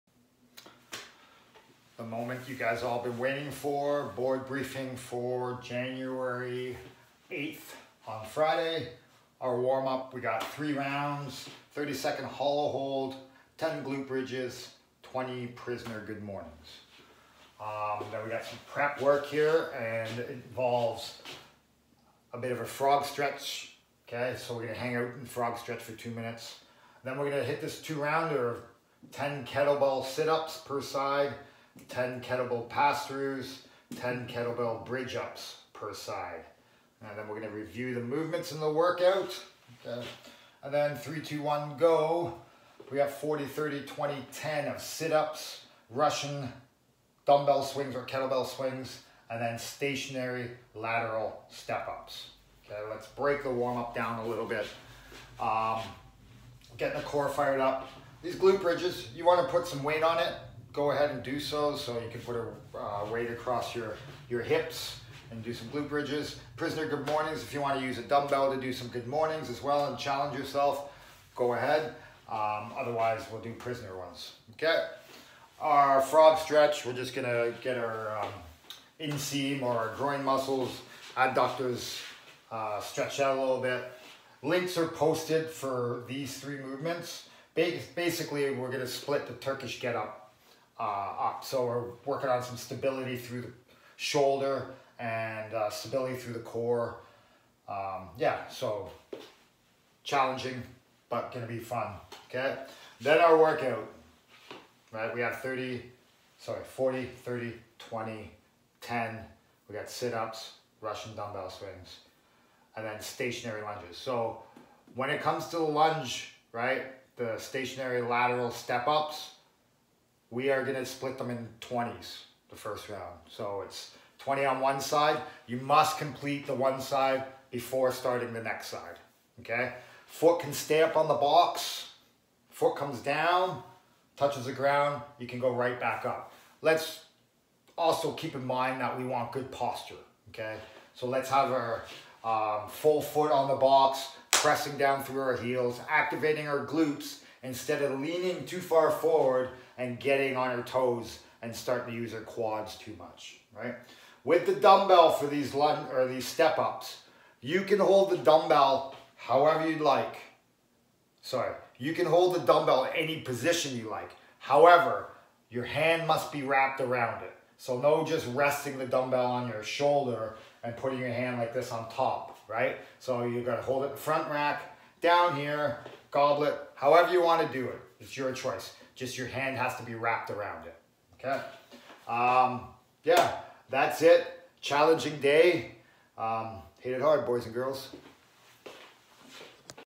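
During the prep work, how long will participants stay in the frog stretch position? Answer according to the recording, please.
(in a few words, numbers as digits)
2 minutes.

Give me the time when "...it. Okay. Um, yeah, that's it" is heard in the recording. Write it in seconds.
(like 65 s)
180 s.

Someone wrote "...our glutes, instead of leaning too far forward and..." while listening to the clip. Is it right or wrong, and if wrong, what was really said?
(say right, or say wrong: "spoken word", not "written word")
right.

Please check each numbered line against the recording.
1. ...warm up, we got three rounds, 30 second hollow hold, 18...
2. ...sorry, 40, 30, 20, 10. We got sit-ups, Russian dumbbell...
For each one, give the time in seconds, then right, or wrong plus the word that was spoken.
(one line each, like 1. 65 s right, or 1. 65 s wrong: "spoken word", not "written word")
1. 9 s wrong: "10", not "18"
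2. 106 s right.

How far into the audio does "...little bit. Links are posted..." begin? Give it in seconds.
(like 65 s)
83 s.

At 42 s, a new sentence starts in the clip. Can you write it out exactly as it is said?
We have 40, 30, 20, 10 of sit-ups, Russian dumbbell swings or kettlebell swings, and then stationary lateral step-ups.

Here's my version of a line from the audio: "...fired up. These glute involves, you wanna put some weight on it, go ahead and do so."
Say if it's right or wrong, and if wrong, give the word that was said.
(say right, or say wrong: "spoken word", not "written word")
wrong: "bridges", not "involves".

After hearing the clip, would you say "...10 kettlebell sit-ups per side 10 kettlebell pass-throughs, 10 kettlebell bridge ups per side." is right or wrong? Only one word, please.
right.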